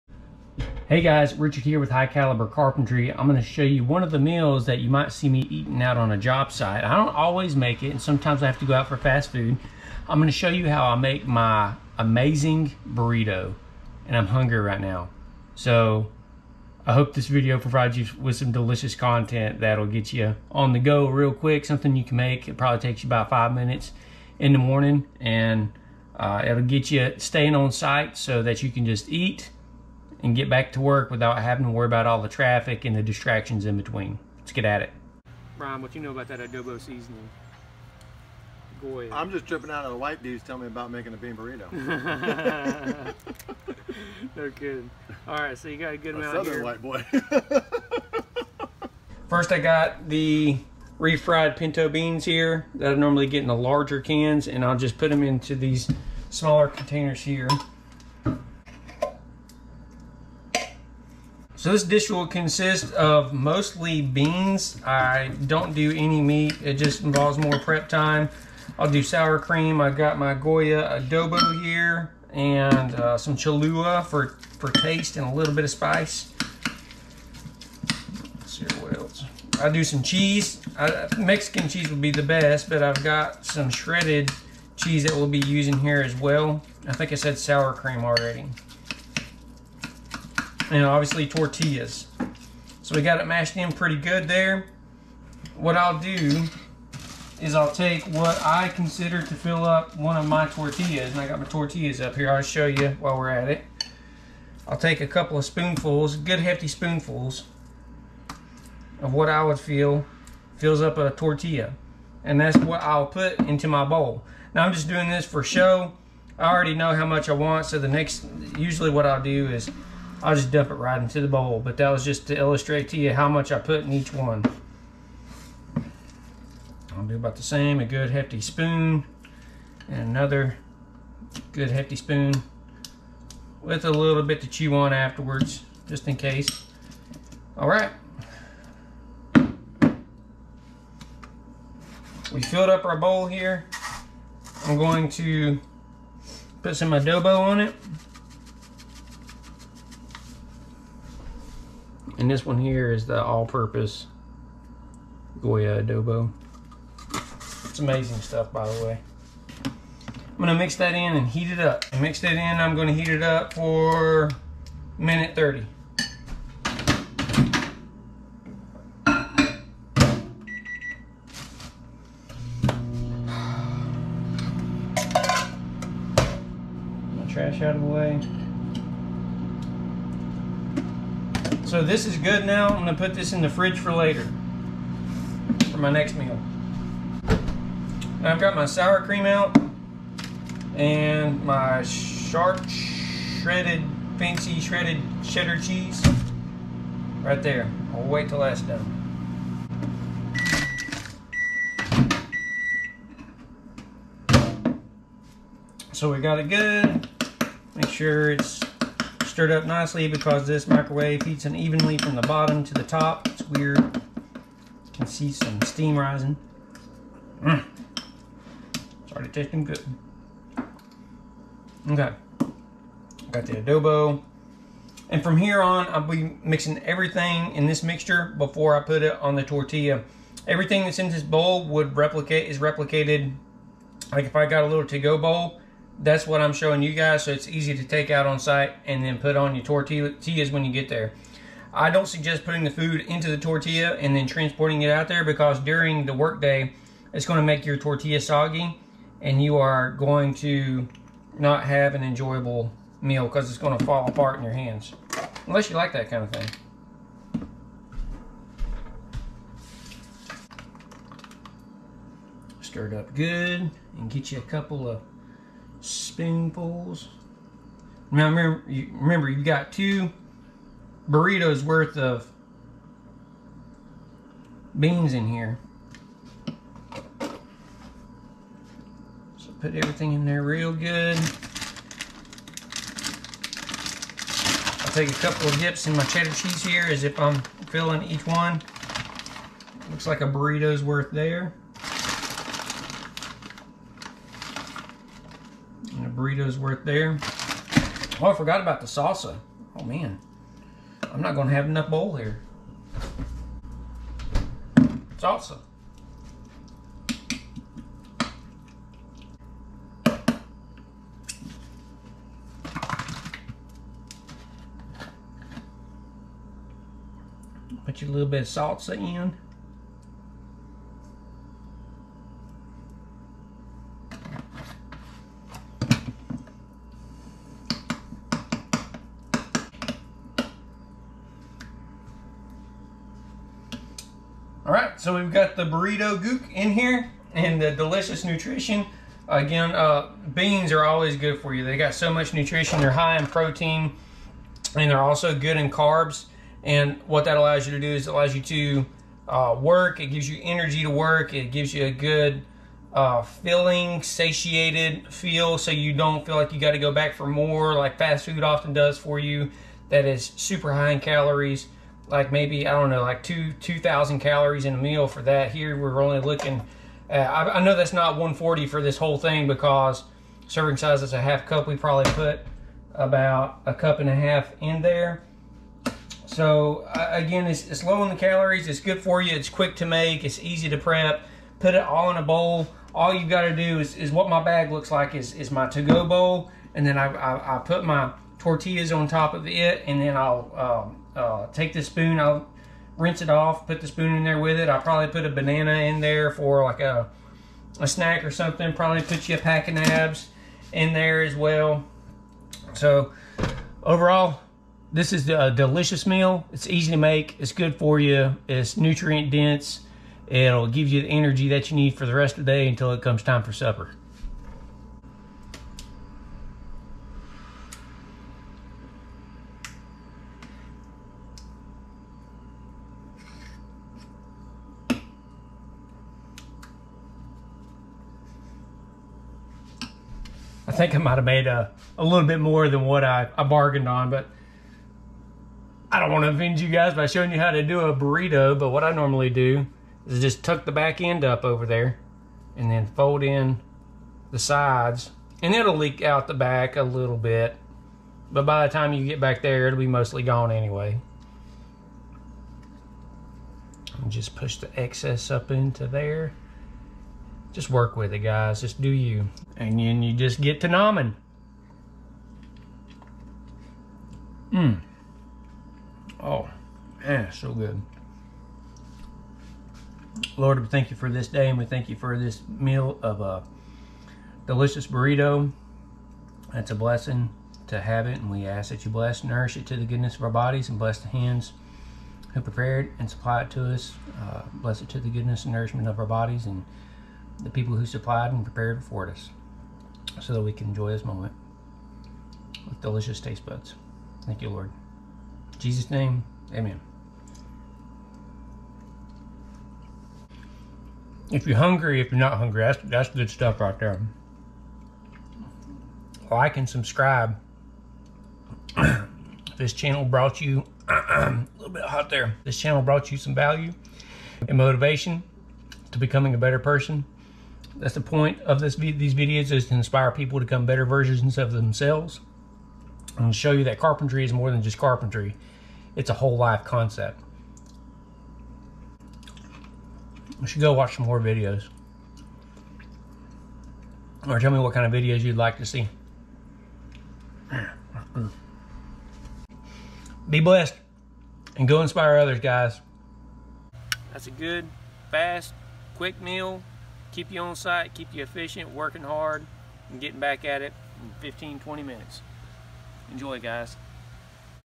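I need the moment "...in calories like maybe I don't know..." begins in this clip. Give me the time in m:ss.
6:00.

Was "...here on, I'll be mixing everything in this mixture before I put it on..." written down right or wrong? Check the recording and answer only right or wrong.
right.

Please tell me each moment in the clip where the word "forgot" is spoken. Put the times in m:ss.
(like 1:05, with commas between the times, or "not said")
4:58.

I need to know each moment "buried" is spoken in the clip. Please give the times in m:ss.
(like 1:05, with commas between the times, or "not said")
not said.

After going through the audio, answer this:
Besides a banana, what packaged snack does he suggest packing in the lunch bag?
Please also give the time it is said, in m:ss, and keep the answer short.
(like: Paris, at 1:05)
a pack of nabs, at 6:39.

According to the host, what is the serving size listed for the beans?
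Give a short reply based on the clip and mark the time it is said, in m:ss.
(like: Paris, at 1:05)
a half cup, at 6:11.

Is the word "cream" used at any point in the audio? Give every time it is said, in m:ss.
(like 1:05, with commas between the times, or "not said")
1:09, 1:27, 3:09.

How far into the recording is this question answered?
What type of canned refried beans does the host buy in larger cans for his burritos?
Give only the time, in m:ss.
0:51.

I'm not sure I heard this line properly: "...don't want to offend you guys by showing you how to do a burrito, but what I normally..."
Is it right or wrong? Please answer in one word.
right.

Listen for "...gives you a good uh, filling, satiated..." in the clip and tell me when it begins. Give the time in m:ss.
5:51.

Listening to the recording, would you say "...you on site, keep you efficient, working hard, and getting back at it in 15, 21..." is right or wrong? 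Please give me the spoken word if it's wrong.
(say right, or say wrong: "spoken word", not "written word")
wrong: "20", not "21".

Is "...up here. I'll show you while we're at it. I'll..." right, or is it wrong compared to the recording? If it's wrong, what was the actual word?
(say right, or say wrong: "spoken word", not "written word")
right.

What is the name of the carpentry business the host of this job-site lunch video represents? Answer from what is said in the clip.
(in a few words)
High Caliber Carpentry.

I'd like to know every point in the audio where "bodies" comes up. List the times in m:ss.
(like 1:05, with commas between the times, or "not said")
8:00, 8:06.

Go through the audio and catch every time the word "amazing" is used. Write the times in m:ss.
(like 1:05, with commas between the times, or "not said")
0:11, 2:37.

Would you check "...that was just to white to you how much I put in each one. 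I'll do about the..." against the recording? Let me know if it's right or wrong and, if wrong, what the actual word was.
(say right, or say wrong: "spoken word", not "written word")
wrong: "illustrate", not "white".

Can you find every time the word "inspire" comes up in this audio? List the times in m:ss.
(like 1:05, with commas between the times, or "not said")
8:39, 9:01.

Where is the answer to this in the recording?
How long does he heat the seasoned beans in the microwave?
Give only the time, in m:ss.
2:44.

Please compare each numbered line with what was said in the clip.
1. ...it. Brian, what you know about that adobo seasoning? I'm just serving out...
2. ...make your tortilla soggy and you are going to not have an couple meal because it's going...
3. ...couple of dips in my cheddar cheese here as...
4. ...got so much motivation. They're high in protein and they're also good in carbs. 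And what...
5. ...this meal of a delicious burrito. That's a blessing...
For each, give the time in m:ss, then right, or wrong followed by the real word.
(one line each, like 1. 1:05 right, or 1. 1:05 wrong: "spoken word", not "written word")
1. 0:34 wrong: "tripping", not "serving"
2. 4:07 wrong: "enjoyable", not "couple"
3. 4:45 right
4. 5:41 wrong: "nutrition", not "motivation"
5. 7:52 right.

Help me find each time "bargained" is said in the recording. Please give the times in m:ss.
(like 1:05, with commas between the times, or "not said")
7:13.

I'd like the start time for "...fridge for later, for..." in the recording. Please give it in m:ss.
3:03.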